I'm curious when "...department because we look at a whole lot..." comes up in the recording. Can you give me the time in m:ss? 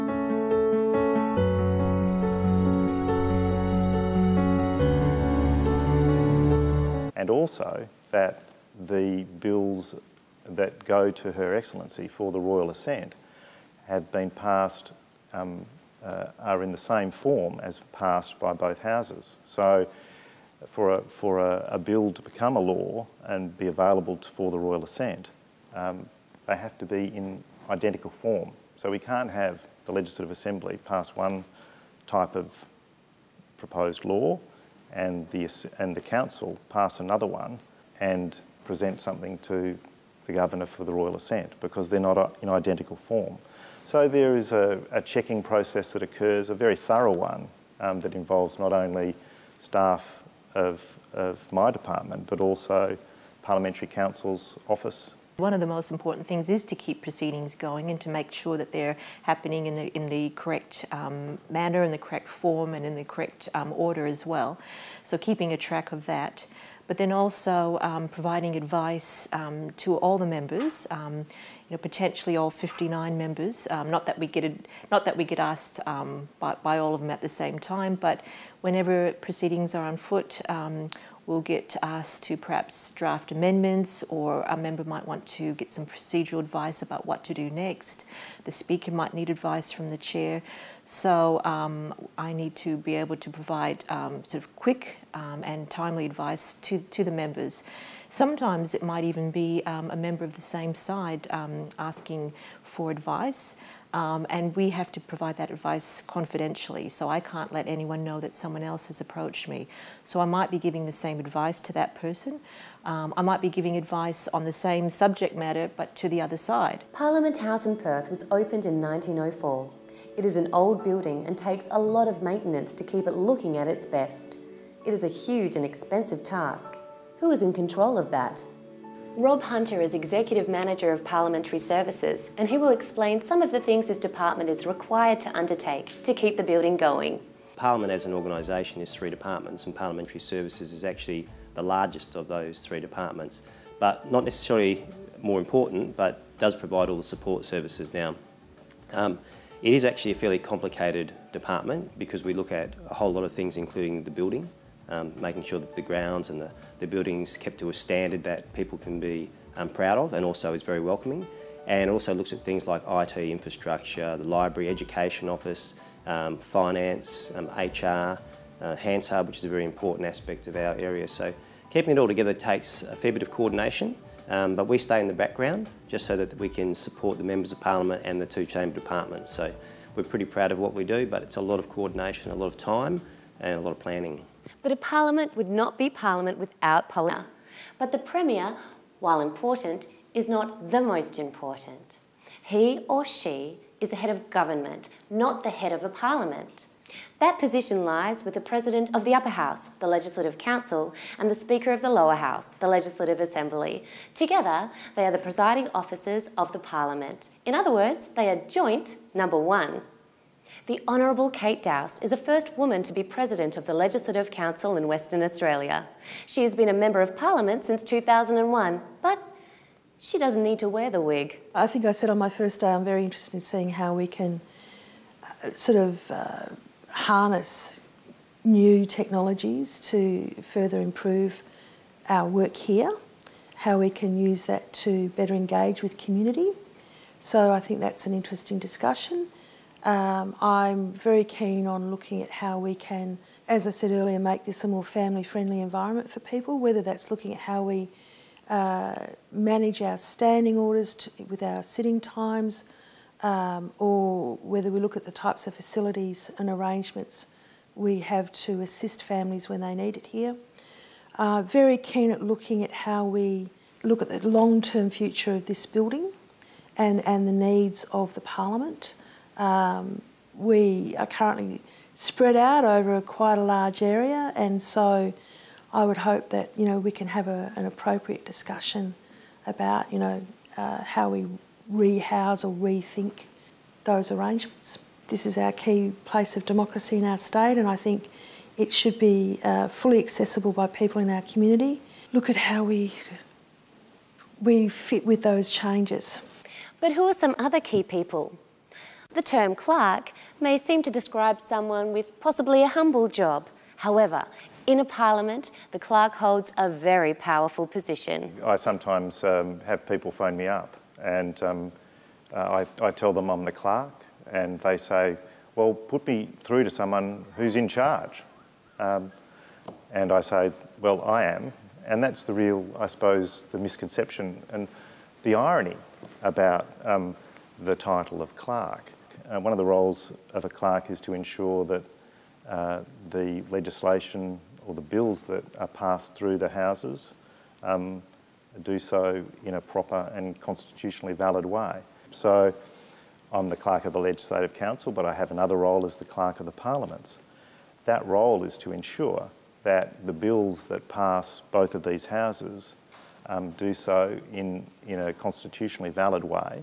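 2:31.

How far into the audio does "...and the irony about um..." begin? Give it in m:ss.
5:24.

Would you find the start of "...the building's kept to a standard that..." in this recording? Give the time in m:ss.
2:36.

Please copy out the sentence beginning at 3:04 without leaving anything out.
But a parliament would not be parliament without Parliament.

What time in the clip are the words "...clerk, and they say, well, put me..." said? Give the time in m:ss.
5:13.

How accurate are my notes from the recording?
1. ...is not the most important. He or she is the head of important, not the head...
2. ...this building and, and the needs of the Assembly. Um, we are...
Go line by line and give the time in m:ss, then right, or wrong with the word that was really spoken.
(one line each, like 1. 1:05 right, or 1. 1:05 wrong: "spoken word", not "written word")
1. 3:10 wrong: "government", not "important"
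2. 4:25 wrong: "Parliament", not "Assembly".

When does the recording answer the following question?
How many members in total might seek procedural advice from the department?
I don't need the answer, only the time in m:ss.
1:12.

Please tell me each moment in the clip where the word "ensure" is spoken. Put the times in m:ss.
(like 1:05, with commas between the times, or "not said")
5:31, 5:48.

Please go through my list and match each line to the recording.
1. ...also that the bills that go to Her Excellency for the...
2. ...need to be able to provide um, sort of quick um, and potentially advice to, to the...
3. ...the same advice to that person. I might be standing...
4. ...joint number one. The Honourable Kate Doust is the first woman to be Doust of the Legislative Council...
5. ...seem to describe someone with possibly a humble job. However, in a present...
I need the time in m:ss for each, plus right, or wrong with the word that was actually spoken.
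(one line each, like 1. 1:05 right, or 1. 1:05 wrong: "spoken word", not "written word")
1. 0:07 right
2. 1:32 wrong: "timely", not "potentially"
3. 1:50 wrong: "giving", not "standing"
4. 3:28 wrong: "President", not "Doust"
5. 5:00 wrong: "parliament", not "present".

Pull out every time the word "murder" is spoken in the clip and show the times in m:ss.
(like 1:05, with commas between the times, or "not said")
not said.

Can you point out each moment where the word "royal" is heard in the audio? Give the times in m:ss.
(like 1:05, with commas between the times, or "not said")
0:12, 0:24, 0:40.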